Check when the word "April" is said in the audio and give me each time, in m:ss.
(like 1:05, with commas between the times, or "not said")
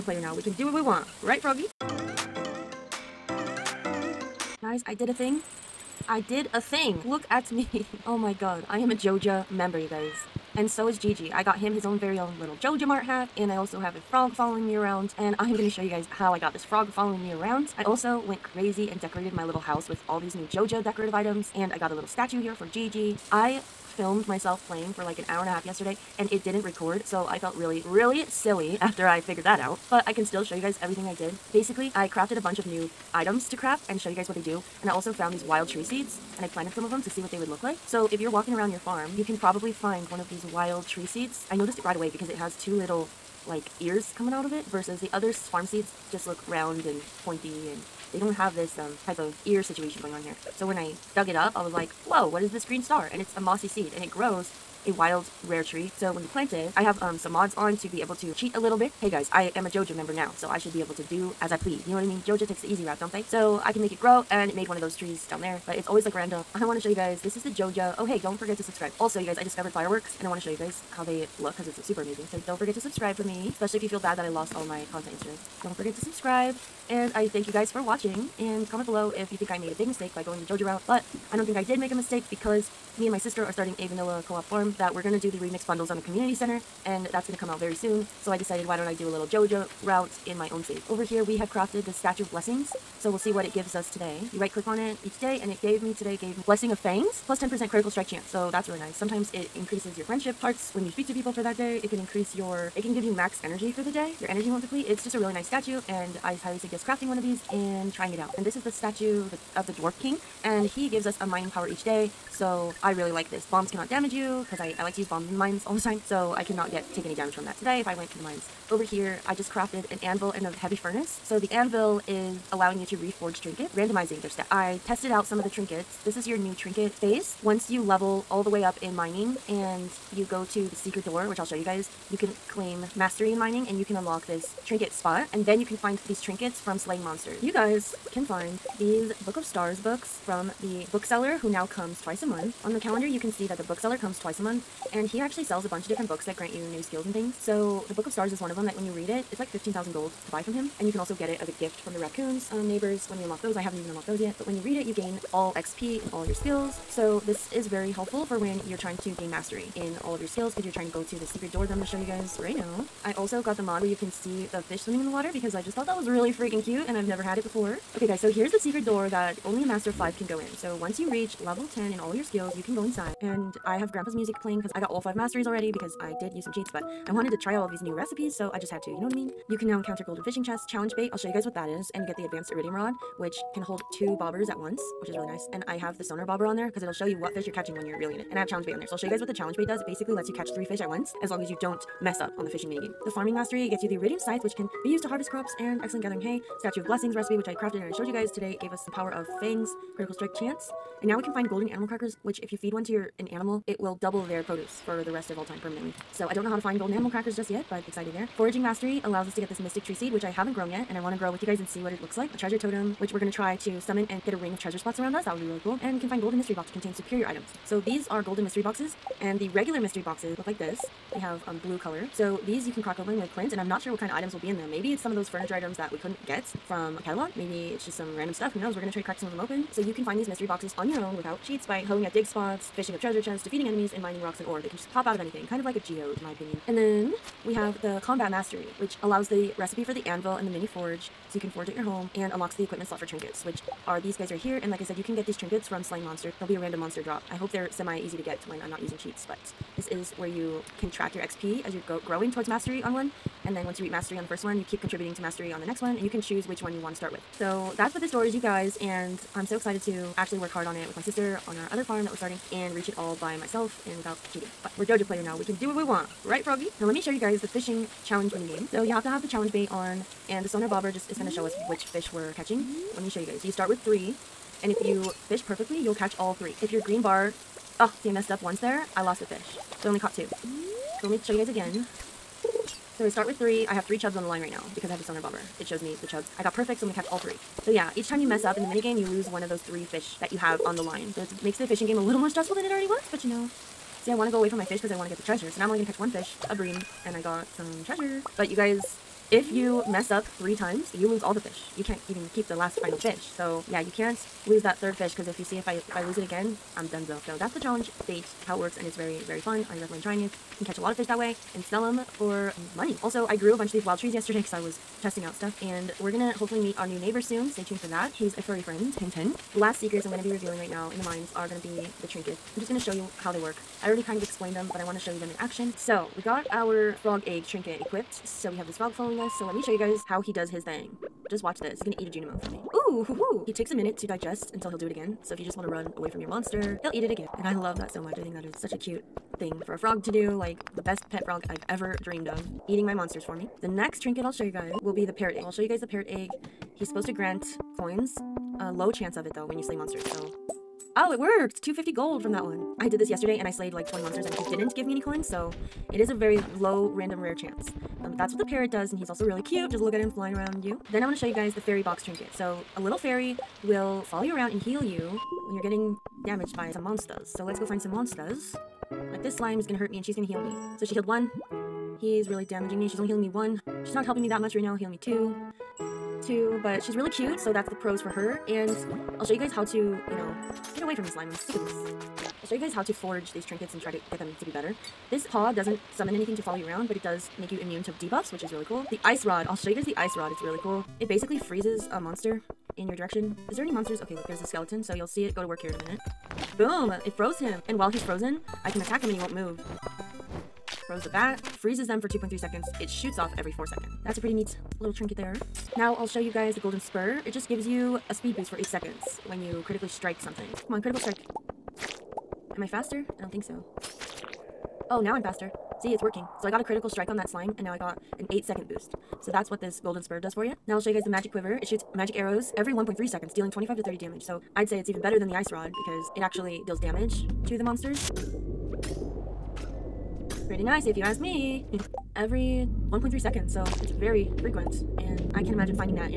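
not said.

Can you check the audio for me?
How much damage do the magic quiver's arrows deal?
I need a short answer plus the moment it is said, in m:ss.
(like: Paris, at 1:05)
25 to 30, at 7:03.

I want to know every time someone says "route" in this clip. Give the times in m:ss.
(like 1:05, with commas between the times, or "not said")
1:02, 1:20, 1:29.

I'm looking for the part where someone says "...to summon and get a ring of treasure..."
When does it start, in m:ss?
3:33.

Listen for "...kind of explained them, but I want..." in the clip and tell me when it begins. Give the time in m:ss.
5:24.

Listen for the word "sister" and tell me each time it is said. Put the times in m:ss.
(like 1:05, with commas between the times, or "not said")
1:23, 4:21.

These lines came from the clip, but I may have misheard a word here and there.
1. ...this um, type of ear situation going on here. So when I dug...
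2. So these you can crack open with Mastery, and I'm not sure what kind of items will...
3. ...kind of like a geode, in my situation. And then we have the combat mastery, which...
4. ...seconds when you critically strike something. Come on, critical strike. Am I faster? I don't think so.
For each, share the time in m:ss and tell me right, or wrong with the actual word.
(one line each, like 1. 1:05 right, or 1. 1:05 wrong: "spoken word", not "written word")
1. 0:48 right
2. 3:42 wrong: "Clint", not "Mastery"
3. 3:55 wrong: "opinion", not "situation"
4. 6:48 right.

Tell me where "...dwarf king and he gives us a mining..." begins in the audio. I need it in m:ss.
1:49.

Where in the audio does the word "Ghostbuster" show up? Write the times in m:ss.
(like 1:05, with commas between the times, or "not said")
not said.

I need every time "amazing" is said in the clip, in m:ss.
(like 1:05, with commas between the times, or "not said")
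1:12.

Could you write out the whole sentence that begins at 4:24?
But we're Joja player now, we can do what we want, right Froggy?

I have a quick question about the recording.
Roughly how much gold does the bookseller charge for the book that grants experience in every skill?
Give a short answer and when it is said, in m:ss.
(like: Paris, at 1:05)
15,000 gold, at 2:29.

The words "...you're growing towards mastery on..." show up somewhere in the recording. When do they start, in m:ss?
4:11.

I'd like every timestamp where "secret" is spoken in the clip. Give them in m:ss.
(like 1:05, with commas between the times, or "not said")
2:10, 2:41, 2:48, 5:19.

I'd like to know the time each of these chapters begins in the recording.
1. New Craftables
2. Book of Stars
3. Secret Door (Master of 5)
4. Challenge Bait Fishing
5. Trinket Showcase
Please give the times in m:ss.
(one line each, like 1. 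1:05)
1. 0:30
2. 2:16
3. 2:42
4. 4:26
5. 5:22.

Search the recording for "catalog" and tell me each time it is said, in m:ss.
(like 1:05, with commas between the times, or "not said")
3:47.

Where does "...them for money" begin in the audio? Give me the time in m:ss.
5:11.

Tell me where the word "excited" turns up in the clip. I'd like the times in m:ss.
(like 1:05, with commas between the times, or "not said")
3:27, 4:19.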